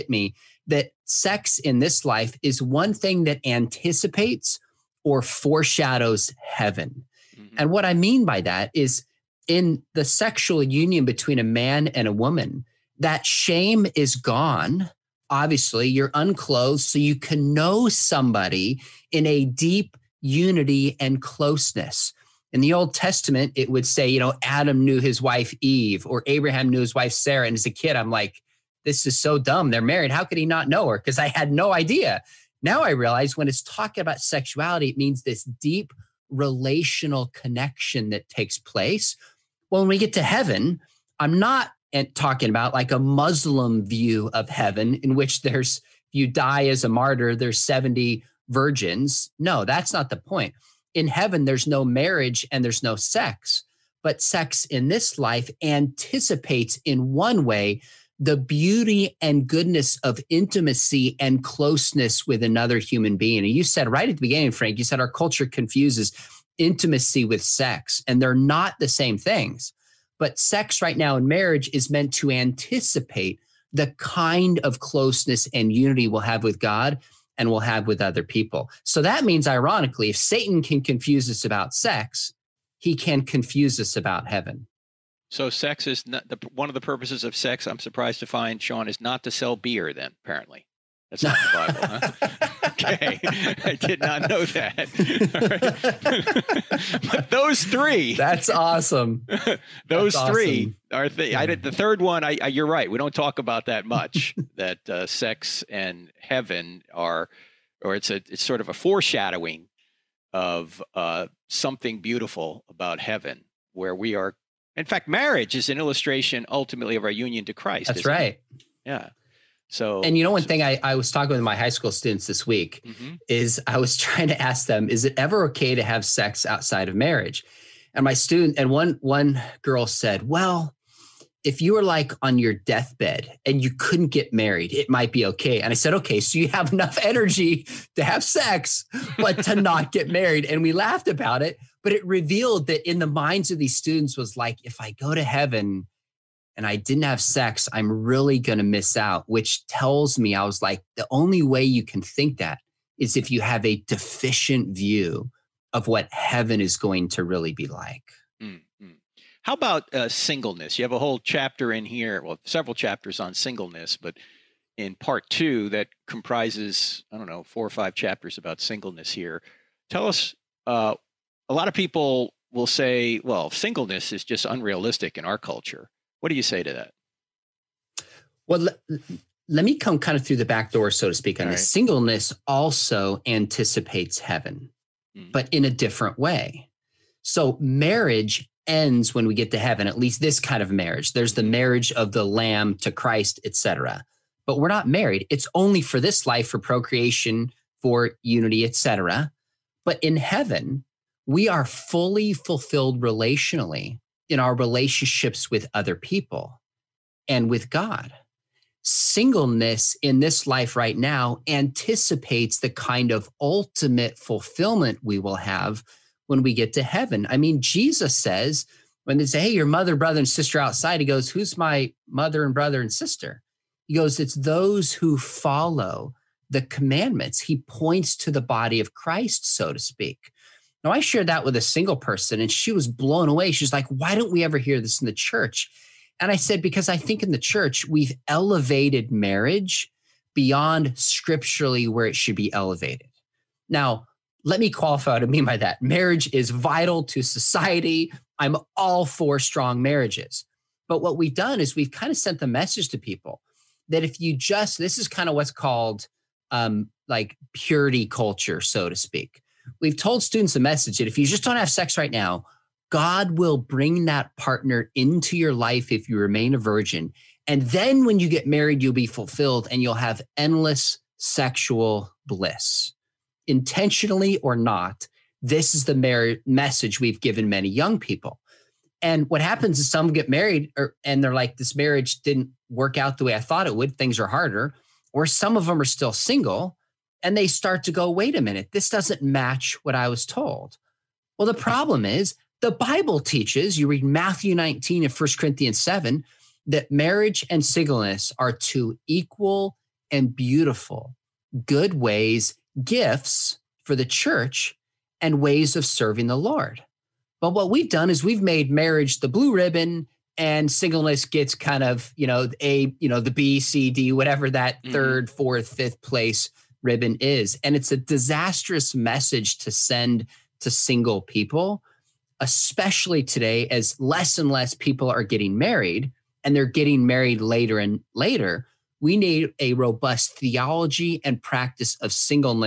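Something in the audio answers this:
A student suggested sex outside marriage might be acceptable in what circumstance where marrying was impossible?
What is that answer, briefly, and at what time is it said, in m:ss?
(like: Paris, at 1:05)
On your deathbed, at 2:12.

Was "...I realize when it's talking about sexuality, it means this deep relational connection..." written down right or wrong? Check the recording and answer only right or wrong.
right.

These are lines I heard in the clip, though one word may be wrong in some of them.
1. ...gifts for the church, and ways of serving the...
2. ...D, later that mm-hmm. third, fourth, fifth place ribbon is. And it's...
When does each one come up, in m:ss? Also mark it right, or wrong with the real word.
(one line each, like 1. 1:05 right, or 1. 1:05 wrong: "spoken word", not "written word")
1. 5:02 right
2. 5:13 wrong: "whatever", not "later".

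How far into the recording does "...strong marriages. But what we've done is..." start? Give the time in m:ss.
4:09.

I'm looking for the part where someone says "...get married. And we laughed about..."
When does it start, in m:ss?
2:19.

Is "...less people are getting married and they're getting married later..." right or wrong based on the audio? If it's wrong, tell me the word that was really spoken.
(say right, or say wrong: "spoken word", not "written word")
right.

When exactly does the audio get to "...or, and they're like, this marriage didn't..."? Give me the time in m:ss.
4:40.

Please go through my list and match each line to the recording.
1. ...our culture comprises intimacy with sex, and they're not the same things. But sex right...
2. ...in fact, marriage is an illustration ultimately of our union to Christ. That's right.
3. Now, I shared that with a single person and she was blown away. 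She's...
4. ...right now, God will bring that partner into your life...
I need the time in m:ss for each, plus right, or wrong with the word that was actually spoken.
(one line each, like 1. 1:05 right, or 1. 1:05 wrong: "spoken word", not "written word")
1. 1:04 wrong: "confuses", not "comprises"
2. 1:54 right
3. 3:50 right
4. 4:21 right.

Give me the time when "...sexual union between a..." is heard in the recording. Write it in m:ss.
0:10.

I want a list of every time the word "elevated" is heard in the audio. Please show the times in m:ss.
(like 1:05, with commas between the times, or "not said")
3:58, 4:02.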